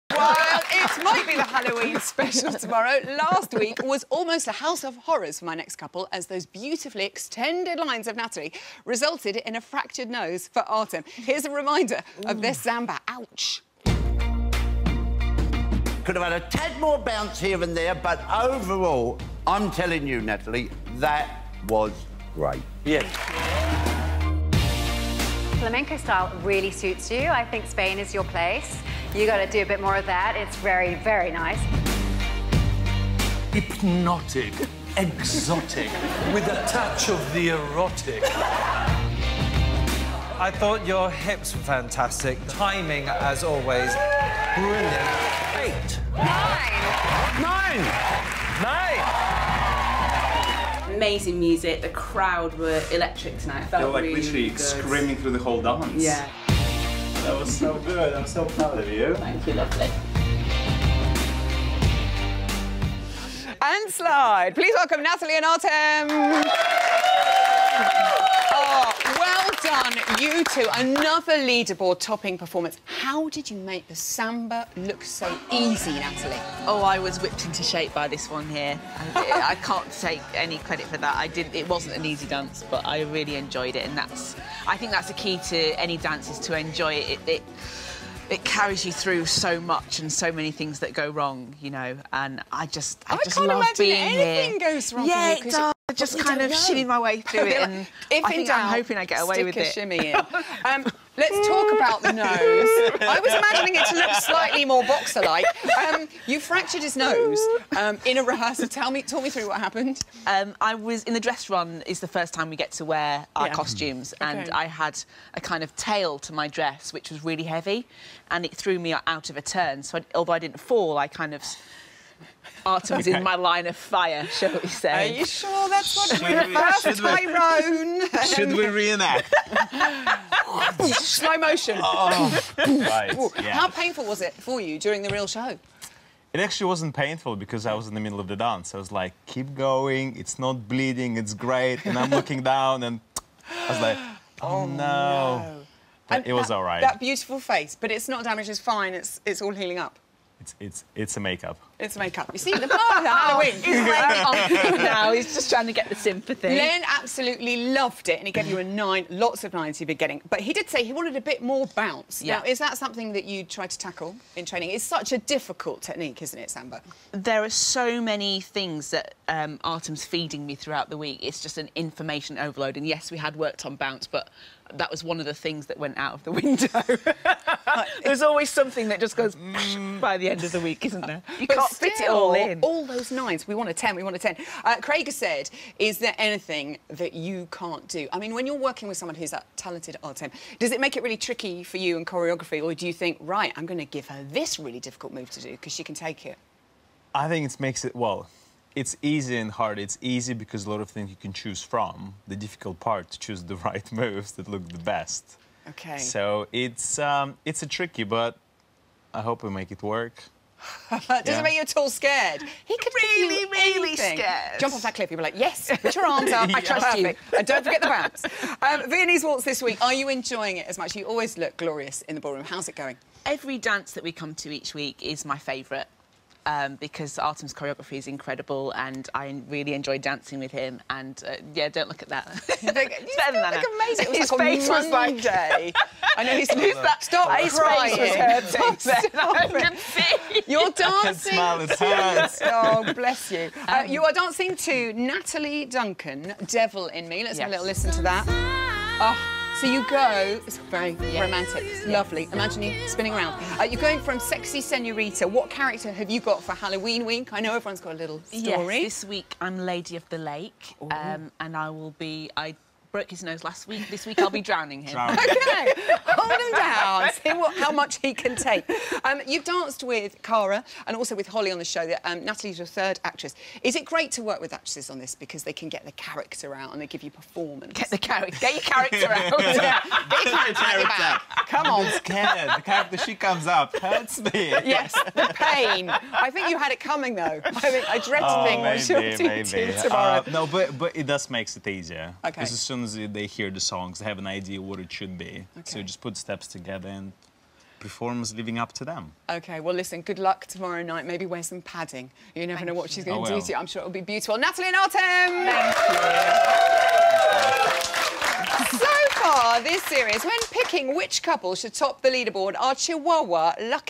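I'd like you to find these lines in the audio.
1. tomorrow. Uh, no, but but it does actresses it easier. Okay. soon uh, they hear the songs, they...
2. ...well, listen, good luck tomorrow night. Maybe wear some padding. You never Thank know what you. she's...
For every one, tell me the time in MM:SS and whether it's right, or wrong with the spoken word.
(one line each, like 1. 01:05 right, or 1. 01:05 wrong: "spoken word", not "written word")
1. 04:49 wrong: "makes", not "actresses"
2. 04:59 right.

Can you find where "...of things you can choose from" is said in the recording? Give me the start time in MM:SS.
03:20.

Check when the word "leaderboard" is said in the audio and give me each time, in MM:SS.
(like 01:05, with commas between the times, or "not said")
01:11, 05:12.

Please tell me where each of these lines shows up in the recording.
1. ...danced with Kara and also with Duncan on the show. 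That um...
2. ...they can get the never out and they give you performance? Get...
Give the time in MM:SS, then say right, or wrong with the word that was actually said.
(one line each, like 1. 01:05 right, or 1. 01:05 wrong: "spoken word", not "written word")
1. 04:29 wrong: "Holly", not "Duncan"
2. 04:35 wrong: "character", not "never".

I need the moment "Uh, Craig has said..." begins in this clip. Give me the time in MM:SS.
03:04.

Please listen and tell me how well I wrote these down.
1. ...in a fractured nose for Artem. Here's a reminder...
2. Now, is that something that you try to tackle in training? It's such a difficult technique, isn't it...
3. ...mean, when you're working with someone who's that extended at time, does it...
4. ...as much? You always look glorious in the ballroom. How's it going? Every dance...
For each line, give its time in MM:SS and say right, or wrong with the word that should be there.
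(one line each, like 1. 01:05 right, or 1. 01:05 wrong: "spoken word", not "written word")
1. 00:09 right
2. 02:42 right
3. 03:08 wrong: "talented", not "extended"
4. 03:40 right.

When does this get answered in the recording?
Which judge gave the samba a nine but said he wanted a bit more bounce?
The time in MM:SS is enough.
02:36.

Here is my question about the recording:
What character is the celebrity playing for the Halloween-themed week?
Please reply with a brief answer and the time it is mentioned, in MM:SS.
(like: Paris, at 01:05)
Lady of the Lake, at 04:19.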